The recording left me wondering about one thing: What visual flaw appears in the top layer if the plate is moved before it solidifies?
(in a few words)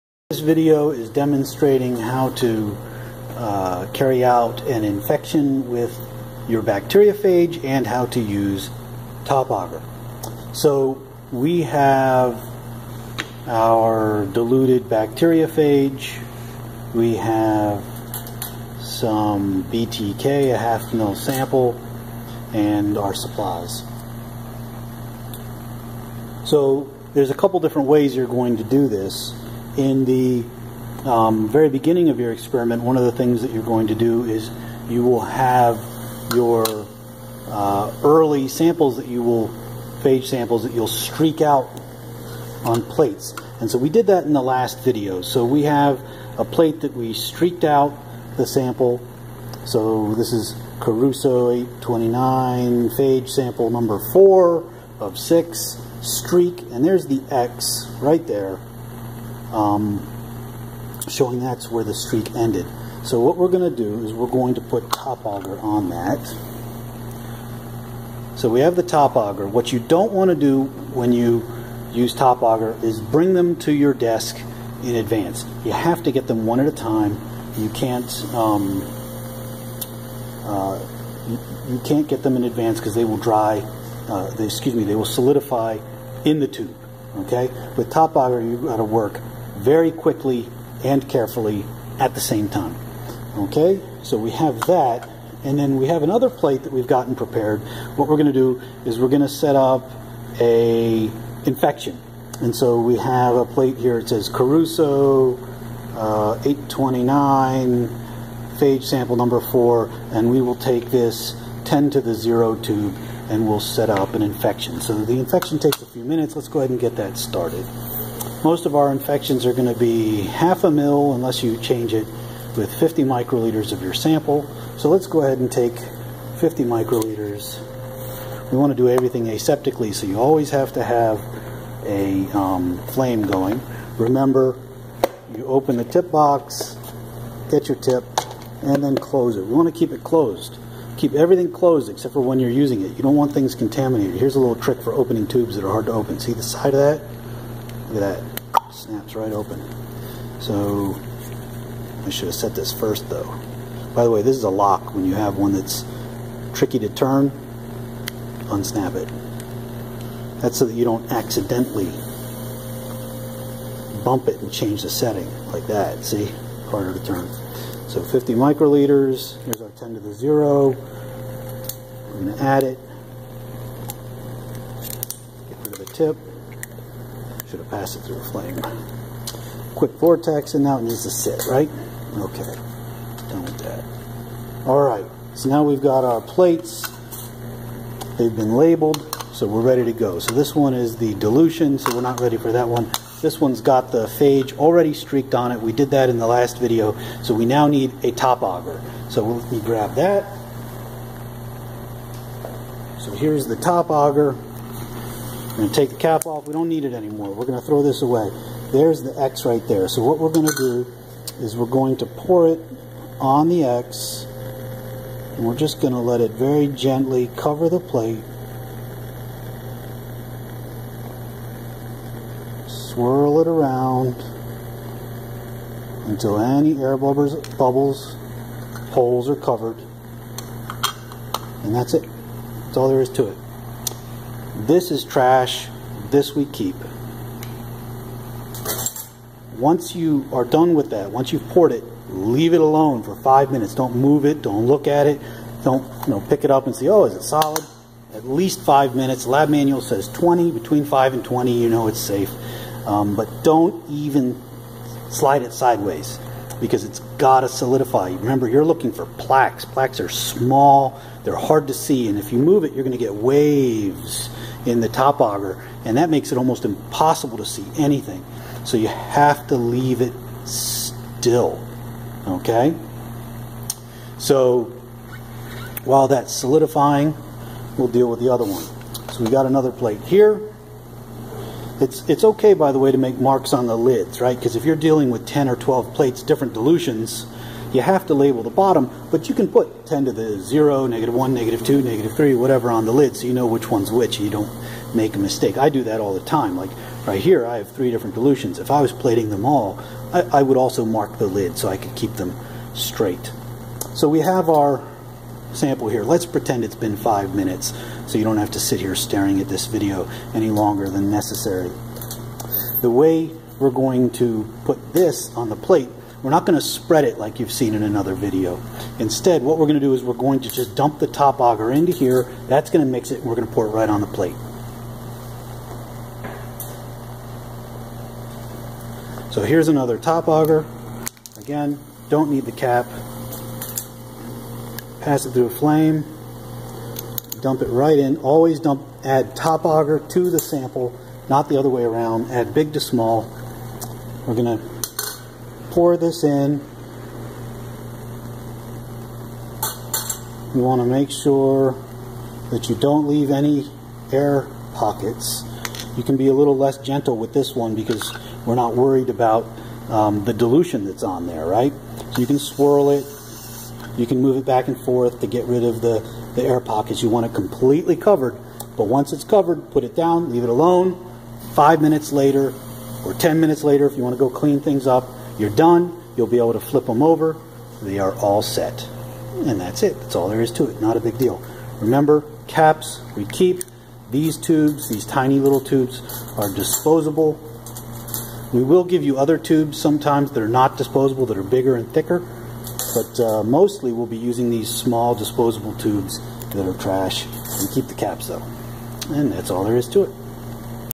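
Waves.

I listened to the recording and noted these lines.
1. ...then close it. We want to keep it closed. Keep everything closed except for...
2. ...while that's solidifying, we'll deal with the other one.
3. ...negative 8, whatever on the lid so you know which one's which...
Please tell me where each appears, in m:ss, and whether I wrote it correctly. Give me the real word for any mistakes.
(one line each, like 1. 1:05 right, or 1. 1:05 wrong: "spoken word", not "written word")
1. 2:18 right
2. 4:35 right
3. 4:51 wrong: "3", not "8".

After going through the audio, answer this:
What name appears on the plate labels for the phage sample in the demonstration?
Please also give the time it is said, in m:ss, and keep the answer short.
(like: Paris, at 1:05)
Caruso 829, at 0:50.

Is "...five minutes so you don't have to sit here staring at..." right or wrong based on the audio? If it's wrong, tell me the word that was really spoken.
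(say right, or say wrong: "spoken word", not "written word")
right.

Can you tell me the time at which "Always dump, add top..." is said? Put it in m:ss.
5:38.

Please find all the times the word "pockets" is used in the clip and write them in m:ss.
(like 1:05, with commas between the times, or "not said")
5:54, 6:06.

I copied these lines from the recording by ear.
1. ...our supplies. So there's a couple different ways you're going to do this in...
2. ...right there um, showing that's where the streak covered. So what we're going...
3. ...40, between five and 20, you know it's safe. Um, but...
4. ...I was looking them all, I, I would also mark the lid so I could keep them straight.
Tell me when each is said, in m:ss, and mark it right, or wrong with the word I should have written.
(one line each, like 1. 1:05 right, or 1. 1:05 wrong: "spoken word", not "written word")
1. 0:22 right
2. 0:58 wrong: "ended", not "covered"
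3. 4:10 wrong: "20", not "40"
4. 4:58 wrong: "plating", not "looking".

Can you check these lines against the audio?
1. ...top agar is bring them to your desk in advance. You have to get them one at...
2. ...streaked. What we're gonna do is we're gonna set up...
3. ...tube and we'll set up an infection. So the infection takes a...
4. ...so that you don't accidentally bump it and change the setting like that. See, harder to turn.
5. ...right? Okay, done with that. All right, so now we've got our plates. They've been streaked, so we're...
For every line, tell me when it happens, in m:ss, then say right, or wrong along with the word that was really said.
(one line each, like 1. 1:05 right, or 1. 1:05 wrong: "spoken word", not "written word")
1. 1:12 right
2. 1:37 wrong: "prepared", not "streaked"
3. 1:52 right
4. 2:40 right
5. 3:01 wrong: "labeled", not "streaked".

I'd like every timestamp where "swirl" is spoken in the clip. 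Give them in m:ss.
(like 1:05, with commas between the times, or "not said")
3:42, 6:02.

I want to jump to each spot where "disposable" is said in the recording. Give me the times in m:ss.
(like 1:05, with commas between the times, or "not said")
6:26, 6:30, 6:35.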